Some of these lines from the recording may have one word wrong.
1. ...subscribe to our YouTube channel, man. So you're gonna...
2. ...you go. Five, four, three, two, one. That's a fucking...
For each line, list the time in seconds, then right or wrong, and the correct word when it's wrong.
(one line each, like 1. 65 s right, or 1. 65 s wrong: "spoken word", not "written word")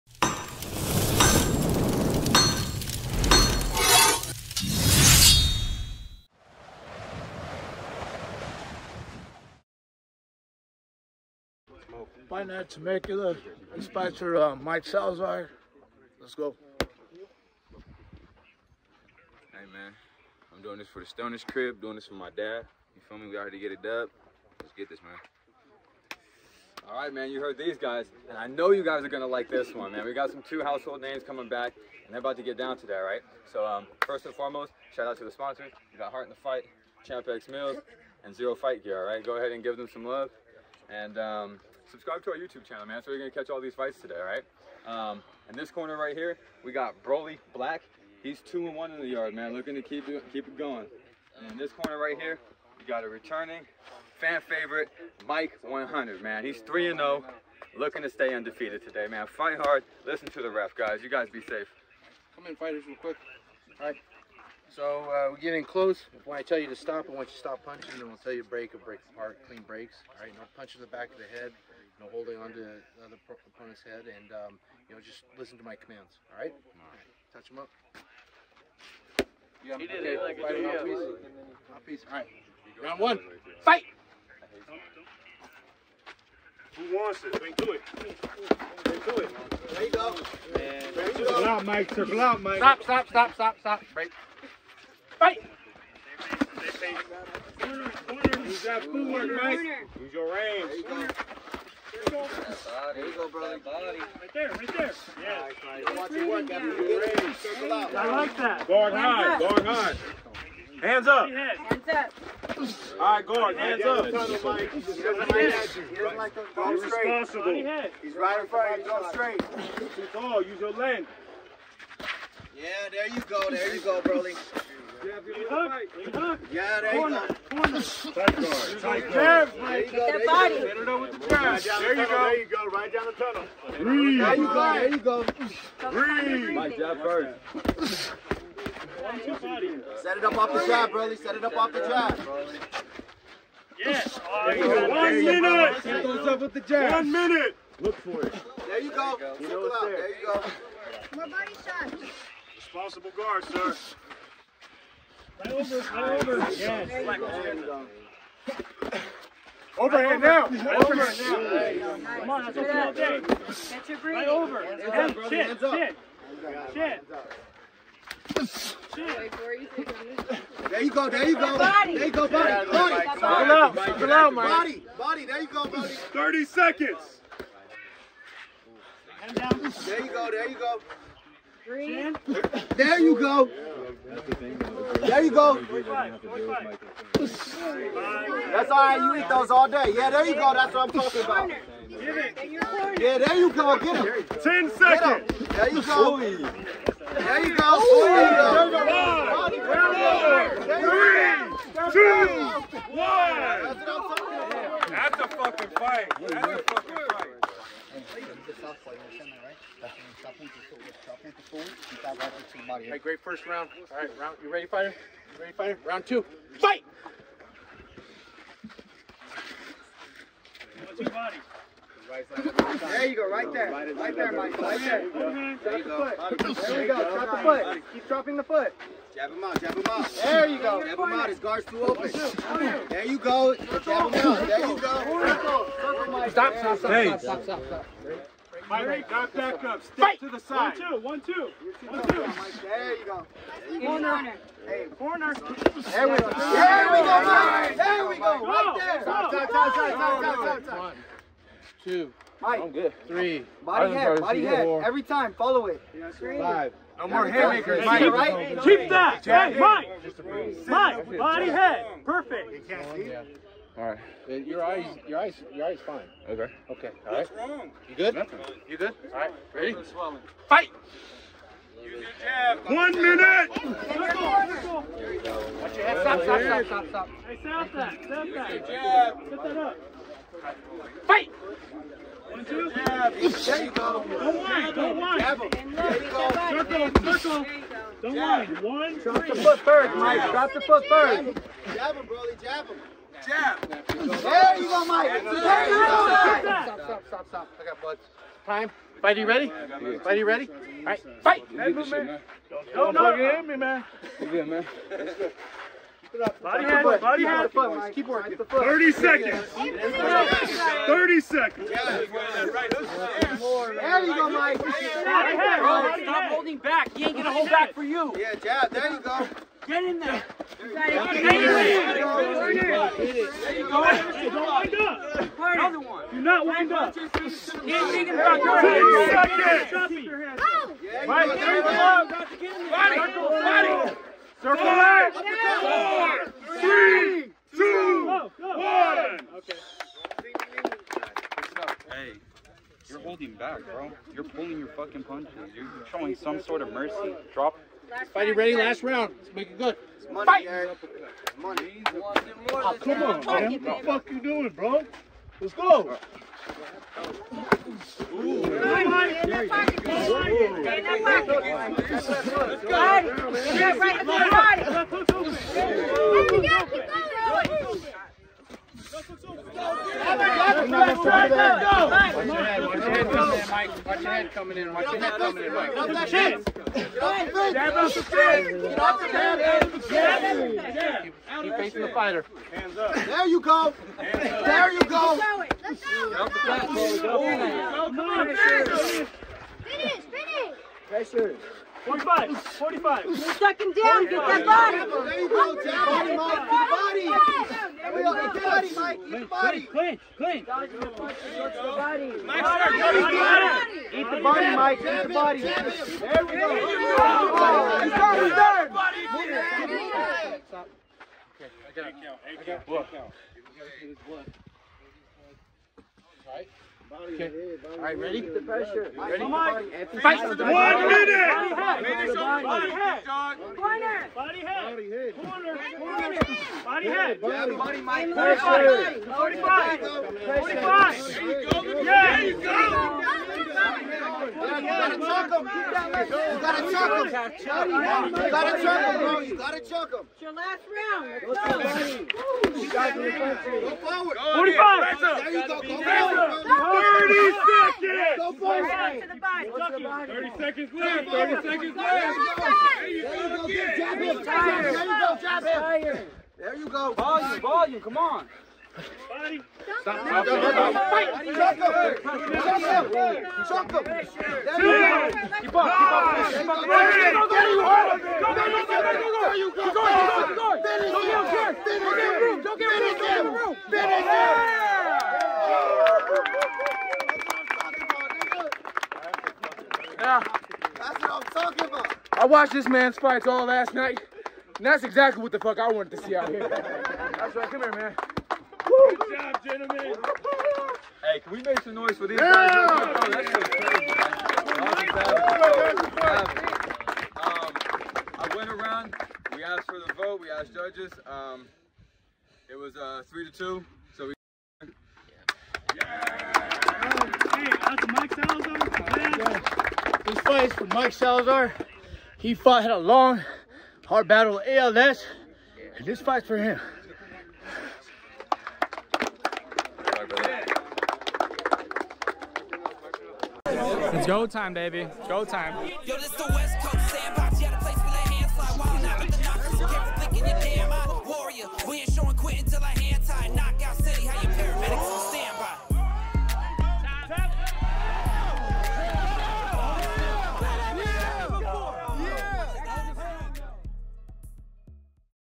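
1. 41 s right
2. 197 s right.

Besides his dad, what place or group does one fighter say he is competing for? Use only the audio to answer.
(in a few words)
Stoners crib.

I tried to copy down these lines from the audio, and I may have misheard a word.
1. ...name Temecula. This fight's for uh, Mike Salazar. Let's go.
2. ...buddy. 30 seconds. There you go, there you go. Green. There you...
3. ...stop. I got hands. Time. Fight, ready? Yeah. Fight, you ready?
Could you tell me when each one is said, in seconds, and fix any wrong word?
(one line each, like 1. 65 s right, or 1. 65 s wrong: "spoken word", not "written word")
1. 12 s right
2. 175 s right
3. 297 s wrong: "bloods", not "hands".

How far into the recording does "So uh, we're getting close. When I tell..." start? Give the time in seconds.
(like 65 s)
64 s.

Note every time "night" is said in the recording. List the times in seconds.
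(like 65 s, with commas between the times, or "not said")
483 s.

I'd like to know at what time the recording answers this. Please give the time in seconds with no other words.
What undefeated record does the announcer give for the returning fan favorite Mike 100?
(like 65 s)
56 s.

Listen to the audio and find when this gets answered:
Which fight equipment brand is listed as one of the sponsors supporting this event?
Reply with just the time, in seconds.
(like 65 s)
38 s.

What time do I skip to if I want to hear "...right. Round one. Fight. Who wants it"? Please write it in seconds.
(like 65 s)
82 s.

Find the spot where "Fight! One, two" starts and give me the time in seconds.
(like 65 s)
281 s.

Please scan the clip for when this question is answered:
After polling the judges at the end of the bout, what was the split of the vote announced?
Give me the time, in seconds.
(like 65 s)
503 s.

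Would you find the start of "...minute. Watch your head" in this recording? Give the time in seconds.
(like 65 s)
272 s.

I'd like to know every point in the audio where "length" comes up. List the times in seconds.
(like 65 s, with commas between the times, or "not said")
120 s.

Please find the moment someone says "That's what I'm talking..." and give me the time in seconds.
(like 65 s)
190 s.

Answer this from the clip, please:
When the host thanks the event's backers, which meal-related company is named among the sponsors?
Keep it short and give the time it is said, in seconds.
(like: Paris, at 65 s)
Champ X Meals, at 37 s.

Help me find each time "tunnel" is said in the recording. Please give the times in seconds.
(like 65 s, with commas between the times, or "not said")
133 s.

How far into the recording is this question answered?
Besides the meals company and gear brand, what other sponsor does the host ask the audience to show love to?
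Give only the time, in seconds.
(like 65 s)
36 s.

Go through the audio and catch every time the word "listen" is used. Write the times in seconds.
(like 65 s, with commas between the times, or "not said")
60 s, 75 s.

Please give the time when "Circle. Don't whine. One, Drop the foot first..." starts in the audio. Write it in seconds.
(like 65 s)
287 s.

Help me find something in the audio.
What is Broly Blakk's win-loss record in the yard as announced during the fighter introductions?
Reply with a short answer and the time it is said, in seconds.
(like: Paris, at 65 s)
2-1, at 48 s.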